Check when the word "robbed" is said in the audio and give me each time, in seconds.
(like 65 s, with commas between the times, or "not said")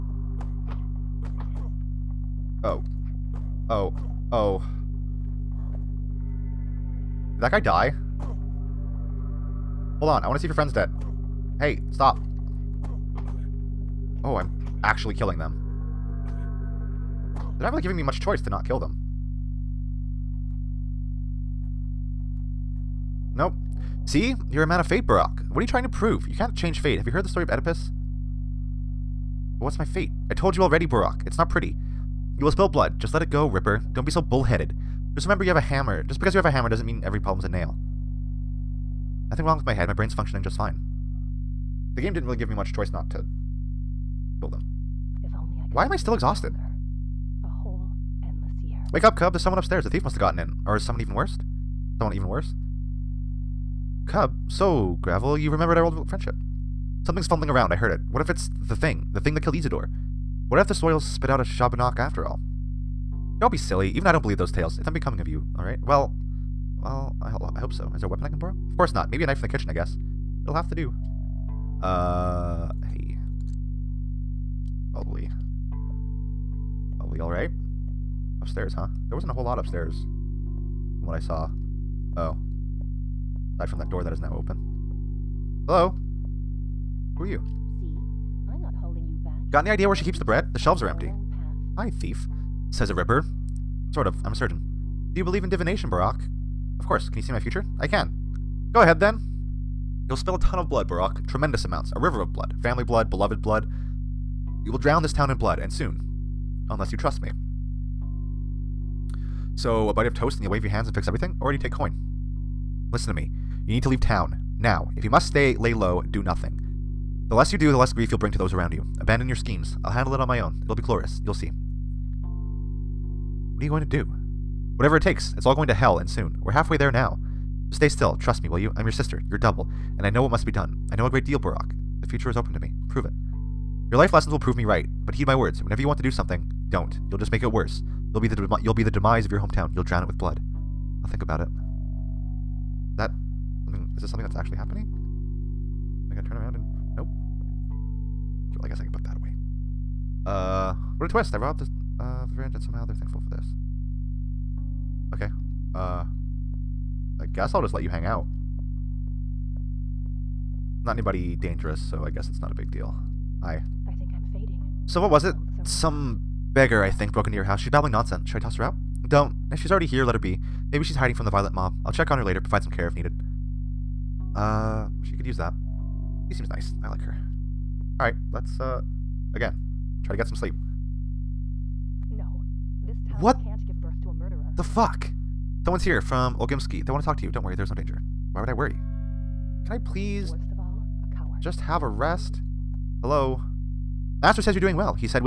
151 s.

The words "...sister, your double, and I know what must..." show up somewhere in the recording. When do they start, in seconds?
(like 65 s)
128 s.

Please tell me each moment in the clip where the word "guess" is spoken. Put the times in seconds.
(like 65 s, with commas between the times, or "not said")
69 s, 148 s, 157 s, 162 s.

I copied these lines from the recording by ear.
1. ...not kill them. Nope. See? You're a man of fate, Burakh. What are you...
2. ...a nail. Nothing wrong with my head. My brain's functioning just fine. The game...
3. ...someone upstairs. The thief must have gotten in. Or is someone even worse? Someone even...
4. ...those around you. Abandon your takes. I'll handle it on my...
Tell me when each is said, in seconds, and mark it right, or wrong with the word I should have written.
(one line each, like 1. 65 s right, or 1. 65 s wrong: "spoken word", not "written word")
1. 18 s right
2. 37 s right
3. 49 s right
4. 118 s wrong: "schemes", not "takes".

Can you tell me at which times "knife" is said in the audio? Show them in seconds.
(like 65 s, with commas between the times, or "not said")
69 s.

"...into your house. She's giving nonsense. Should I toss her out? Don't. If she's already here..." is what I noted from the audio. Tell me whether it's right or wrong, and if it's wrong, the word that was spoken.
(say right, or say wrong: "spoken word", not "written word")
wrong: "babbling", not "giving".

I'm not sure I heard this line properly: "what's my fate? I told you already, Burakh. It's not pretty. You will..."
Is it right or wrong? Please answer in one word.
right.